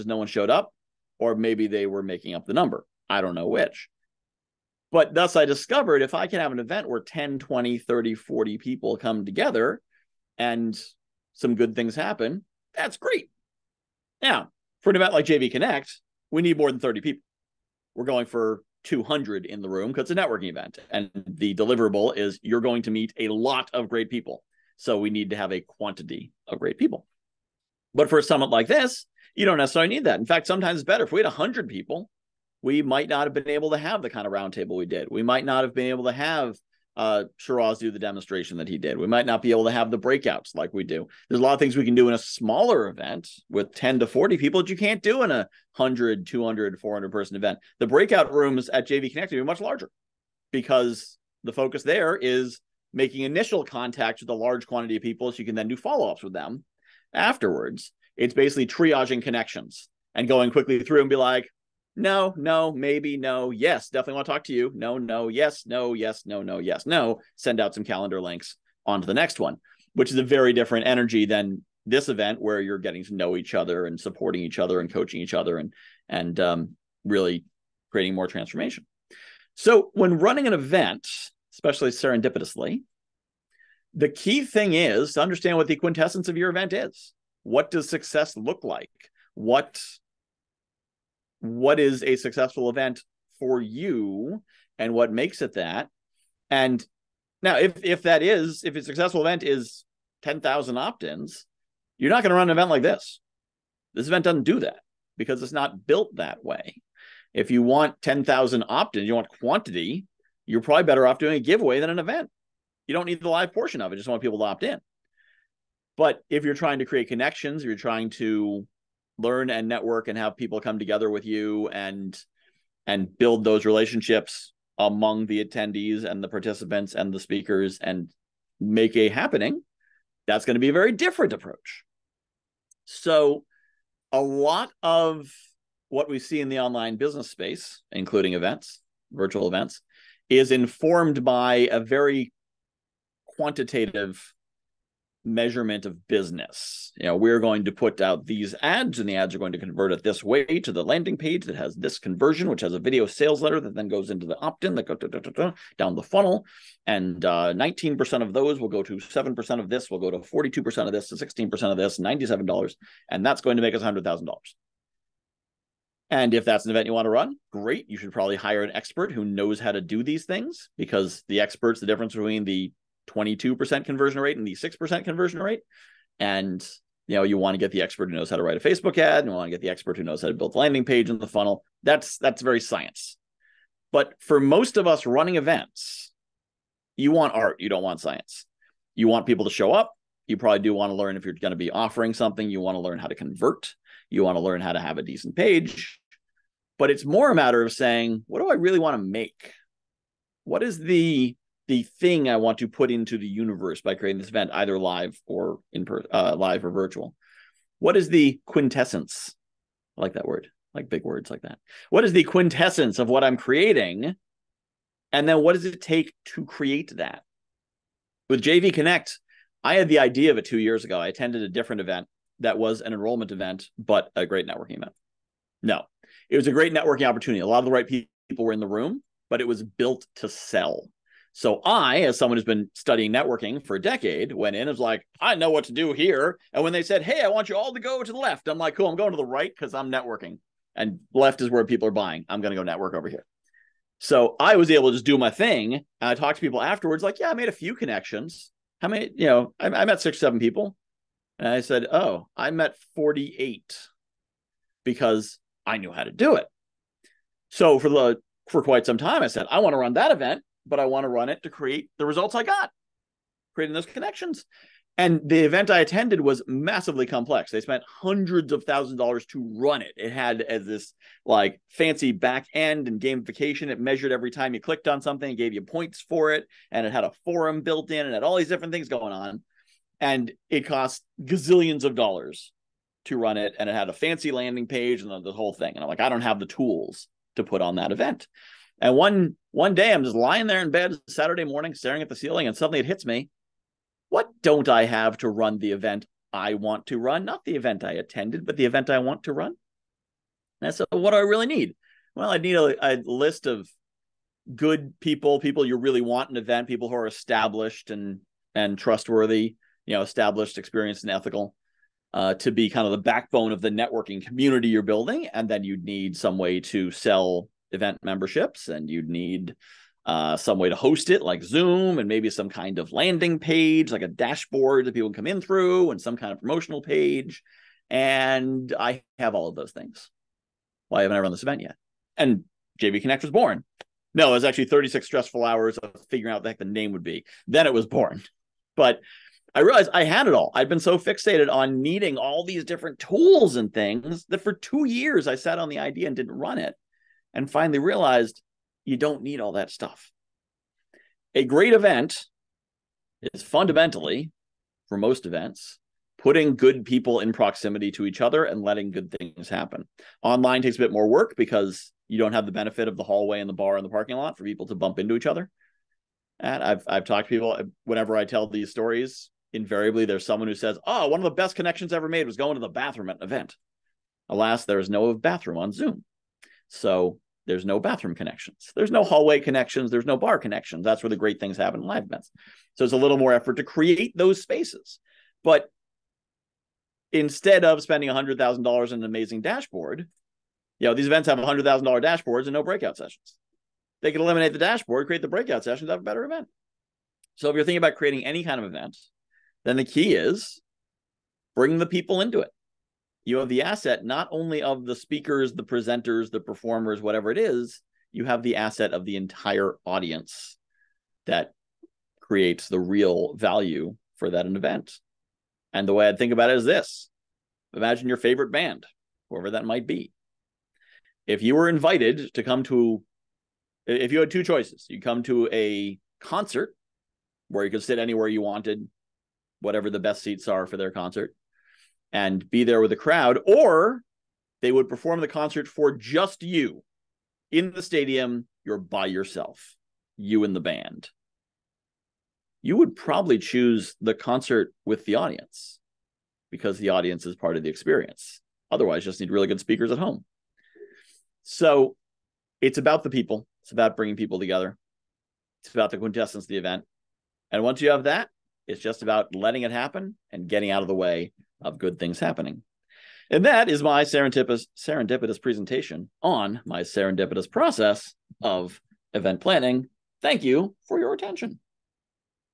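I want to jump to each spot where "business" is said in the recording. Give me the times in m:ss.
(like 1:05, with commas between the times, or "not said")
2:16, 2:26.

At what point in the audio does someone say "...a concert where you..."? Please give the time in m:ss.
7:05.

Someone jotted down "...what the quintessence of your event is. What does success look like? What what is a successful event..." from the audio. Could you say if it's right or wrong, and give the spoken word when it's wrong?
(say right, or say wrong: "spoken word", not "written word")
right.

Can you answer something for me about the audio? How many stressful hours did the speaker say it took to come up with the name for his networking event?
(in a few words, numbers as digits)
36.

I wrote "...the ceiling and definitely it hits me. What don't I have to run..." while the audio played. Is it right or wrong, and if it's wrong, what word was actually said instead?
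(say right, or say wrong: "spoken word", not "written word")
wrong: "suddenly", not "definitely".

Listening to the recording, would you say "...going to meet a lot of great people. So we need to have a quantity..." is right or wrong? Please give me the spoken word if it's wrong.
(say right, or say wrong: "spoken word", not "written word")
right.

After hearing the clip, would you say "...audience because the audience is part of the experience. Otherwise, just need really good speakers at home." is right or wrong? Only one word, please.
right.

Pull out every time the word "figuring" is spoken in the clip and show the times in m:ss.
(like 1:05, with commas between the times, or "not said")
5:36.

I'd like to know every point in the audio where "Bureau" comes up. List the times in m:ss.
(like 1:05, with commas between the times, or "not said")
not said.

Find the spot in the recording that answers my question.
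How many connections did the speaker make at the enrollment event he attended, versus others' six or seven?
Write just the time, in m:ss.
4:12.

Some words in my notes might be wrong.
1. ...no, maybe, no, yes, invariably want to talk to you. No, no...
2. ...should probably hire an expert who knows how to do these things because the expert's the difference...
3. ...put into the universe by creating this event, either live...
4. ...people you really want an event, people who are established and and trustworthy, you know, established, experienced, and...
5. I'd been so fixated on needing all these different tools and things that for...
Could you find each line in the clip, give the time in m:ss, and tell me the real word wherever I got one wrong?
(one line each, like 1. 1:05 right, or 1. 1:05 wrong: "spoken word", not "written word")
1. 1:02 wrong: "definitely", not "invariably"
2. 2:47 right
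3. 3:22 right
4. 5:05 right
5. 5:40 right.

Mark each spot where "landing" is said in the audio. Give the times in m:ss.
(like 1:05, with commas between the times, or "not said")
2:30, 3:00, 4:44, 5:22.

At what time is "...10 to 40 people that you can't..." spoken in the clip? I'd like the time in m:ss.
0:43.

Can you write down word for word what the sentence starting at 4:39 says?
And it cost gazillions of dollars to run it.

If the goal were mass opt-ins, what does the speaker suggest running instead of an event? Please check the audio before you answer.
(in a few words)
A giveaway.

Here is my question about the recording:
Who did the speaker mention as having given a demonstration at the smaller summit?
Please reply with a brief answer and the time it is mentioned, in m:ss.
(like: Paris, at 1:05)
Shiraz, at 0:37.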